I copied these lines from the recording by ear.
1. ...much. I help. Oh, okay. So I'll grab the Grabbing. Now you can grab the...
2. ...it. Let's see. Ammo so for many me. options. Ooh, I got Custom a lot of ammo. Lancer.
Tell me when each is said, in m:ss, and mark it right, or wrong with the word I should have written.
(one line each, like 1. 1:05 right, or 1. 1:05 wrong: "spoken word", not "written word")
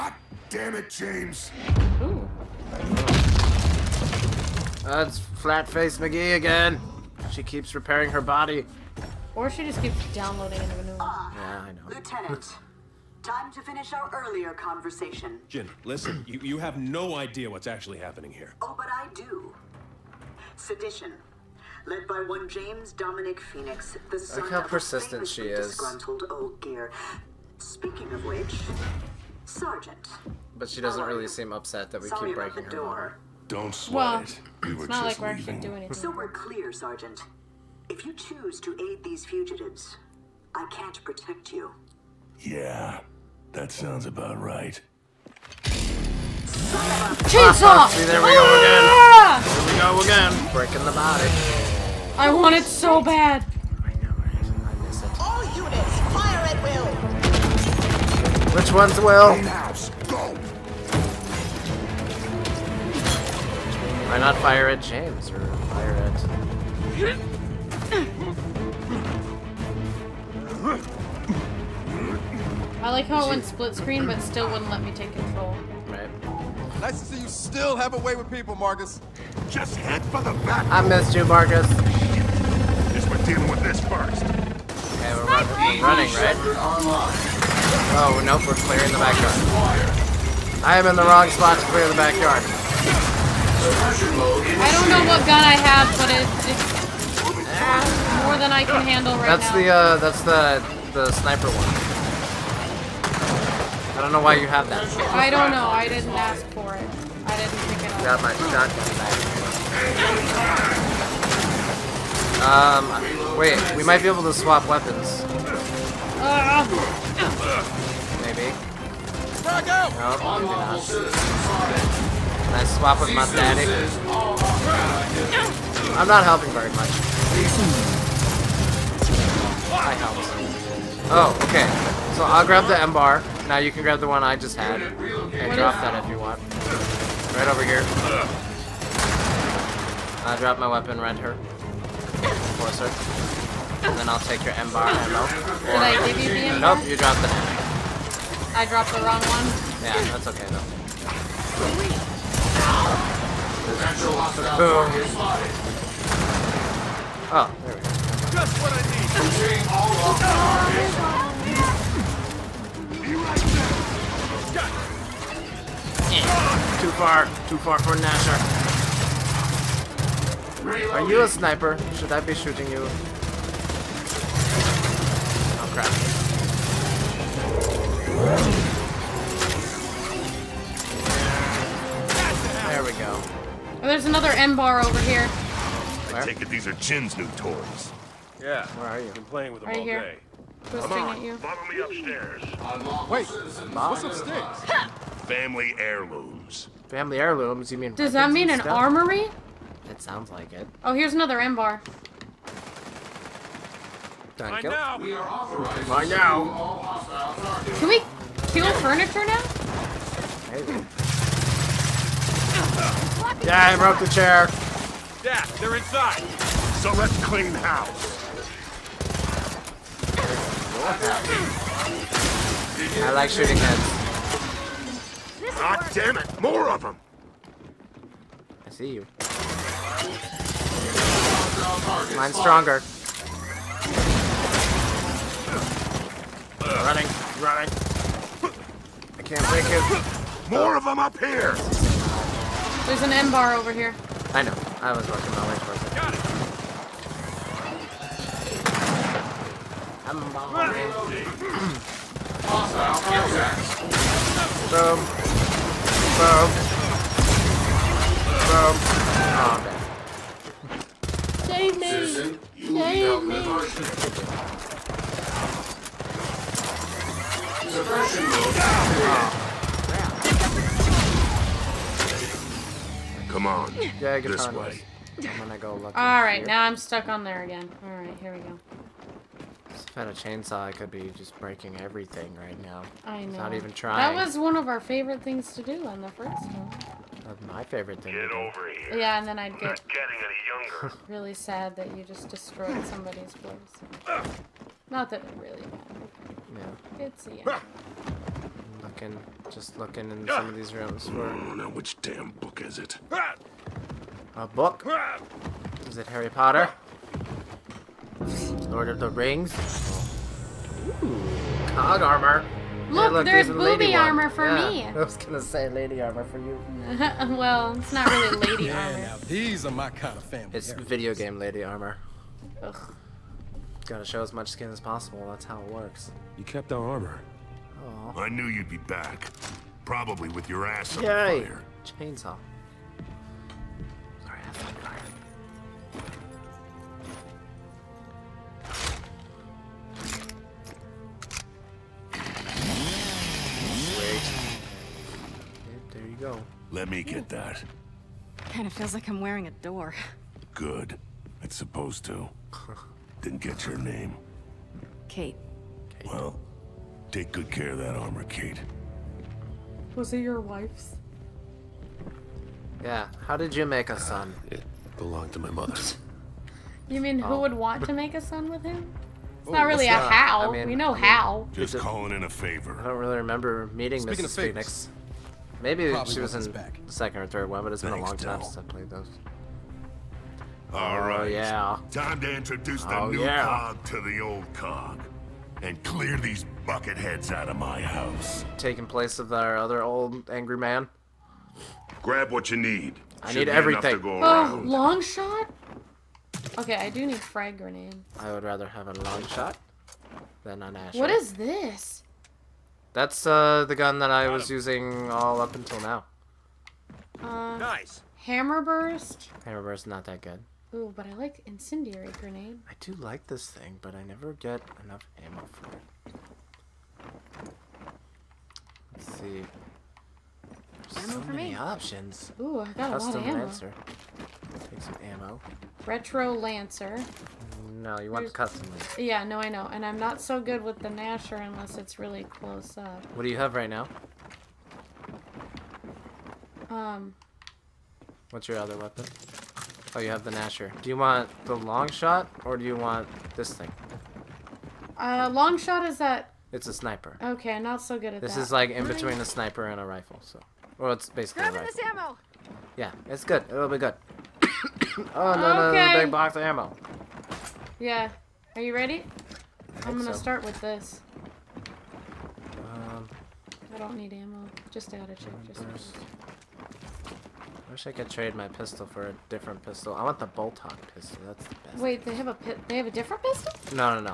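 1. 2:06 wrong: "EMBAR", not "Grabbing"
2. 6:55 right.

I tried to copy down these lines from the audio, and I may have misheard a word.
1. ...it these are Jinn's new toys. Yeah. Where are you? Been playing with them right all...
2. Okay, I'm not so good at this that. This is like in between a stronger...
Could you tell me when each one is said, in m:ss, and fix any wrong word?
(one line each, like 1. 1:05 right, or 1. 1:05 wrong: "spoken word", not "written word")
1. 3:06 right
2. 7:27 wrong: "sniper", not "stronger".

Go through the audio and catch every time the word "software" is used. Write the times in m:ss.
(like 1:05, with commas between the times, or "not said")
not said.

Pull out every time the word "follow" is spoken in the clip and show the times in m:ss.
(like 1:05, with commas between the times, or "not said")
3:11.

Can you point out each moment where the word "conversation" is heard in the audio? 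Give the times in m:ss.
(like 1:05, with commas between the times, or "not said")
0:14.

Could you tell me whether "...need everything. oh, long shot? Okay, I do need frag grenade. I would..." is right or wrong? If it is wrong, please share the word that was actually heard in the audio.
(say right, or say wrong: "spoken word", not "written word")
right.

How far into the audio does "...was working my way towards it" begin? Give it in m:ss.
4:04.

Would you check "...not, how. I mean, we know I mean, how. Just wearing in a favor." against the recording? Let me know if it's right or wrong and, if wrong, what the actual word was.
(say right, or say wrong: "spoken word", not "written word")
wrong: "calling", not "wearing".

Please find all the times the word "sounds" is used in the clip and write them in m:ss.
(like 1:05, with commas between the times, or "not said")
0:43, 3:20.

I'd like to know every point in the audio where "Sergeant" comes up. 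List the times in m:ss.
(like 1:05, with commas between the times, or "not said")
0:29, 0:36.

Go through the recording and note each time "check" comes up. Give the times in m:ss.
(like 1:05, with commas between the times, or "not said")
7:45.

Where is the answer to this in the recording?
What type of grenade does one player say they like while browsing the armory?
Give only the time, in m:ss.
6:51.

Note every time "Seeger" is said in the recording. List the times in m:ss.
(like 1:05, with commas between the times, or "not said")
not said.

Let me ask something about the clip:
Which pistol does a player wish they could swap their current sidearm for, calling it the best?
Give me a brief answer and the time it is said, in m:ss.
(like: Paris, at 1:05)
Boltok, at 7:50.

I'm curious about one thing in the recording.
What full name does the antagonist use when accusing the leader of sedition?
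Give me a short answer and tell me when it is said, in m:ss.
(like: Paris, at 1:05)
James Dominic Fenix, at 0:22.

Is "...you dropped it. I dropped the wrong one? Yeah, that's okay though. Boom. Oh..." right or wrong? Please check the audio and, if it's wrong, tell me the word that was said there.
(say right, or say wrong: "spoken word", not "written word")
right.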